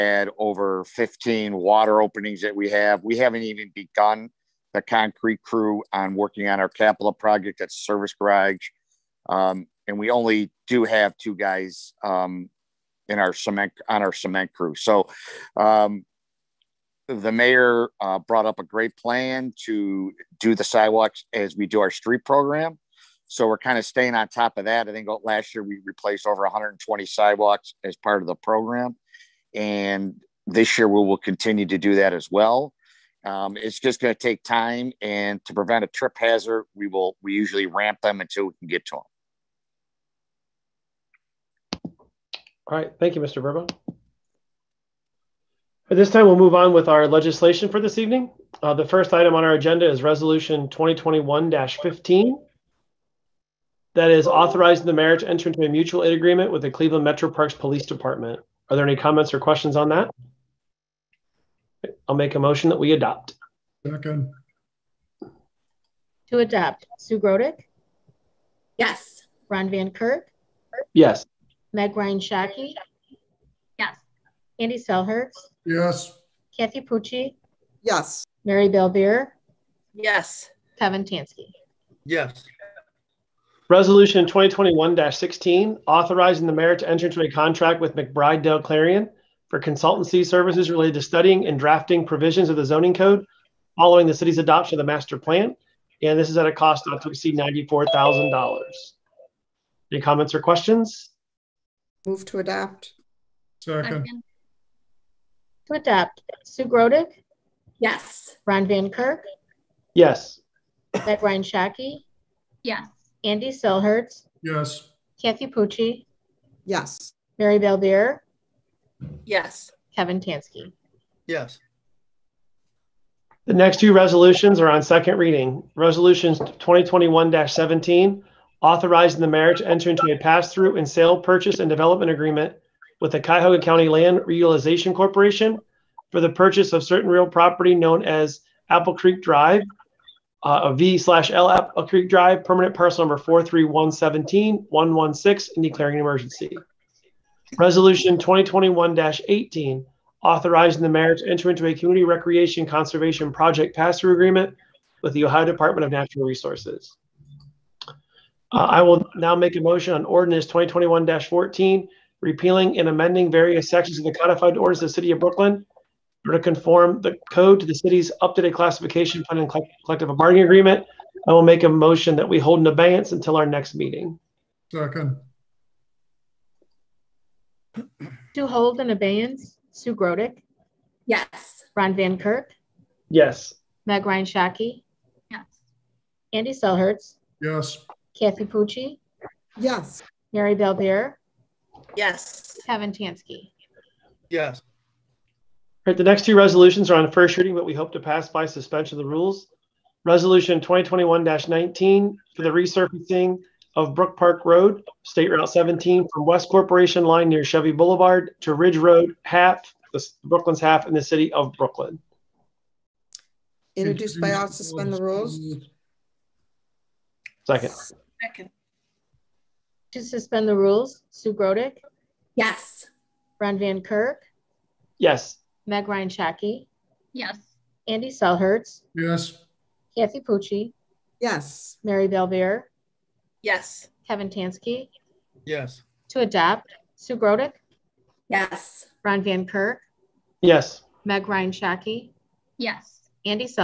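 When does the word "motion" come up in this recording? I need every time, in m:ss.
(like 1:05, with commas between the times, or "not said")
1:02, 2:39, 2:51.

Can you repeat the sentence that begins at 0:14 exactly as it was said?
So um, the mayor uh, brought up a great plan to do the sidewalks as we do our street program.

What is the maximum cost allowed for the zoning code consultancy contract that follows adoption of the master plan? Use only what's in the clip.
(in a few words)
$94,000.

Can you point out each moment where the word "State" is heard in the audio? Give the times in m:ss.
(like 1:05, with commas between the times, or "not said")
3:25.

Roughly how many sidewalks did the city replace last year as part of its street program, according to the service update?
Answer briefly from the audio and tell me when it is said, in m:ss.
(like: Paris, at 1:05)
over 120, at 0:26.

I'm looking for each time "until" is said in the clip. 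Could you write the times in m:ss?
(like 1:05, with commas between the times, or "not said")
0:38, 2:53.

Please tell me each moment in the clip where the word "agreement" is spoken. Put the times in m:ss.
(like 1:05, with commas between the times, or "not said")
0:56, 2:12, 2:34, 2:50.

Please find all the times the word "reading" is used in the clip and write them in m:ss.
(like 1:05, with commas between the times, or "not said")
2:05, 3:17.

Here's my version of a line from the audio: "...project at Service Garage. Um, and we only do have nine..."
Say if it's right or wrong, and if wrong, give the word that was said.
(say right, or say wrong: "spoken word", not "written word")
wrong: "two", not "nine".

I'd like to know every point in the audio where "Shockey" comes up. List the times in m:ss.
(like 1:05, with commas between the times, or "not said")
1:12, 1:51, 3:04, 3:46, 4:01.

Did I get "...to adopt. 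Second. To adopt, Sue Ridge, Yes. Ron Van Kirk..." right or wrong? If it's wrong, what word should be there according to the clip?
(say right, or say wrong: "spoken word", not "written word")
wrong: "Grodick", not "Ridge".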